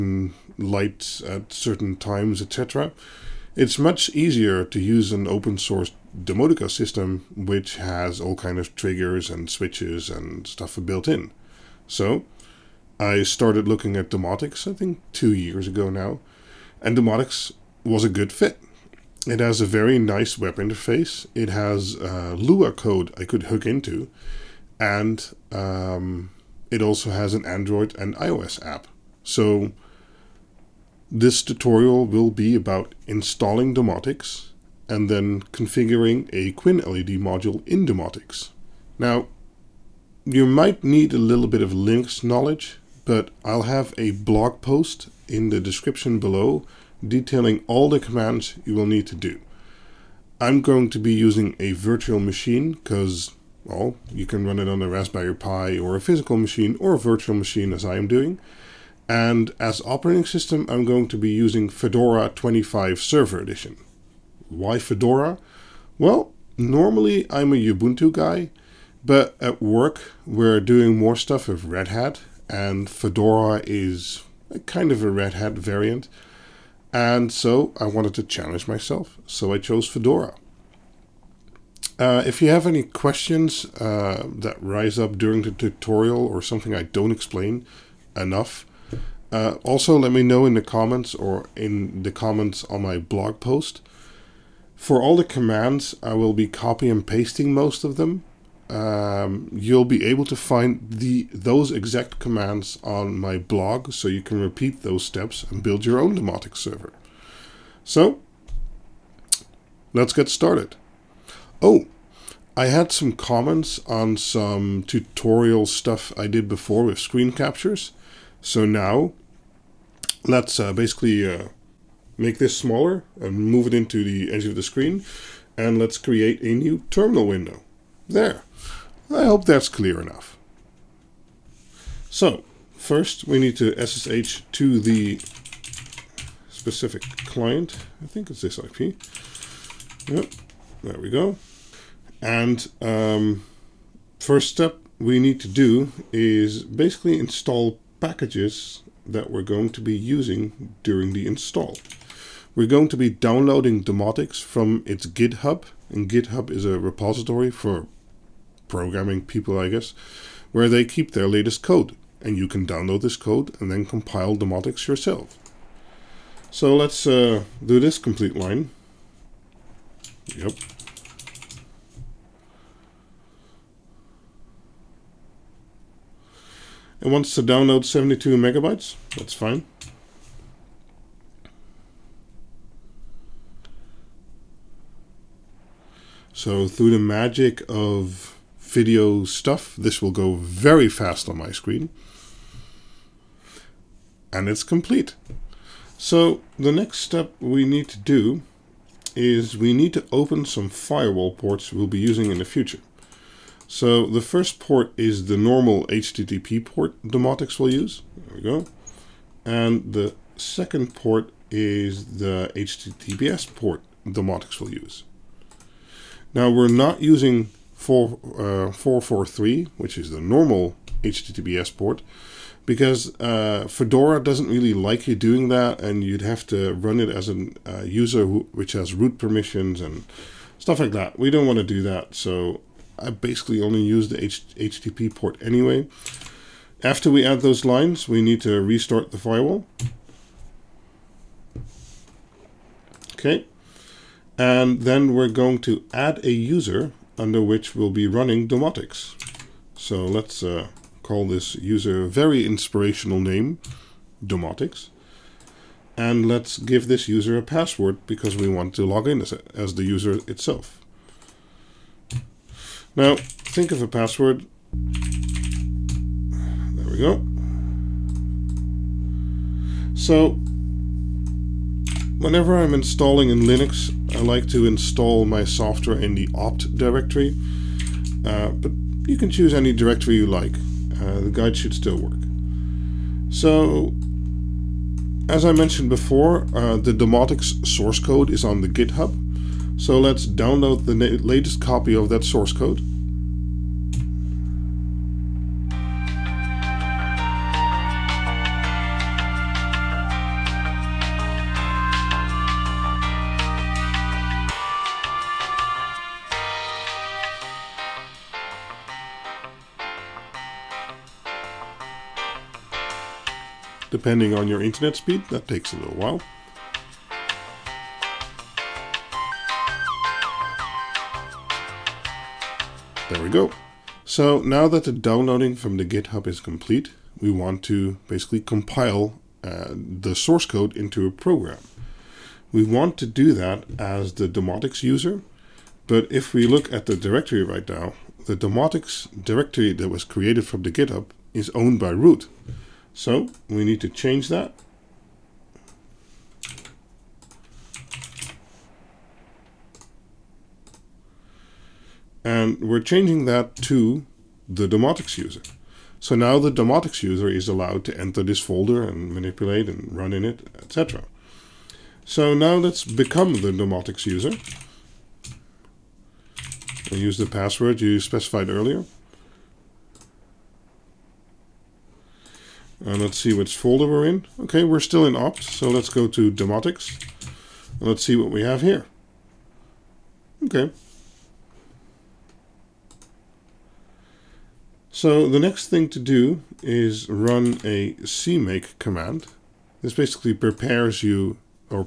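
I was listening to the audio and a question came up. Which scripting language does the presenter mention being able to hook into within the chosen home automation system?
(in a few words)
Lua.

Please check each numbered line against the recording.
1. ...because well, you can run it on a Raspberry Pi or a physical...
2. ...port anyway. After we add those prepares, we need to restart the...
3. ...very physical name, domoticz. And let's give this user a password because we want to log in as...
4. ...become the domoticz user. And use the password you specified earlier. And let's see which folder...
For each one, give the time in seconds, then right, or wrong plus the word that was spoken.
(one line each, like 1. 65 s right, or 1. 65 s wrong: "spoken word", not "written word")
1. 52 s right
2. 235 s wrong: "lines", not "prepares"
3. 252 s wrong: "inspirational", not "physical"
4. 362 s right.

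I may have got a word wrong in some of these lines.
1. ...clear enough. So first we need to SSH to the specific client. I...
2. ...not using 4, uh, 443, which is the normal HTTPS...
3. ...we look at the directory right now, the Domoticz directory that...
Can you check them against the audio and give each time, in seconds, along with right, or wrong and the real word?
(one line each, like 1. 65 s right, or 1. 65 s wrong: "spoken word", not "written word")
1. 129 s right
2. 216 s right
3. 336 s right.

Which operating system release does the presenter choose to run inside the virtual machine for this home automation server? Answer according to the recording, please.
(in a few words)
Fedora 25 Server Edition.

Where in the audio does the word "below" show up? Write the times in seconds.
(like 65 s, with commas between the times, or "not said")
46 s.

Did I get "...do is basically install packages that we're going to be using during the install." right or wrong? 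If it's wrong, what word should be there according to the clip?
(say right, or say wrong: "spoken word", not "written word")
right.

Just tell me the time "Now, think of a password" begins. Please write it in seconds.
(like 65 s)
262 s.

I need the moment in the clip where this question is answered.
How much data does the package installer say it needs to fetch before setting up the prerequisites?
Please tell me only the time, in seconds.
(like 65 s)
177 s.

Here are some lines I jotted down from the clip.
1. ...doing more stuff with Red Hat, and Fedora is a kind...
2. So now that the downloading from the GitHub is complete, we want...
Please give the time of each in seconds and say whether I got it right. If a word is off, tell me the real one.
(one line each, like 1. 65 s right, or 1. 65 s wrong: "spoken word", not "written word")
1. 70 s right
2. 324 s right.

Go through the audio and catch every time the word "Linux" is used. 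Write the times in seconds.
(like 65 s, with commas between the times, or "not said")
41 s, 273 s.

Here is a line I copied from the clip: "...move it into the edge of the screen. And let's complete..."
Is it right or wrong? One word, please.
wrong.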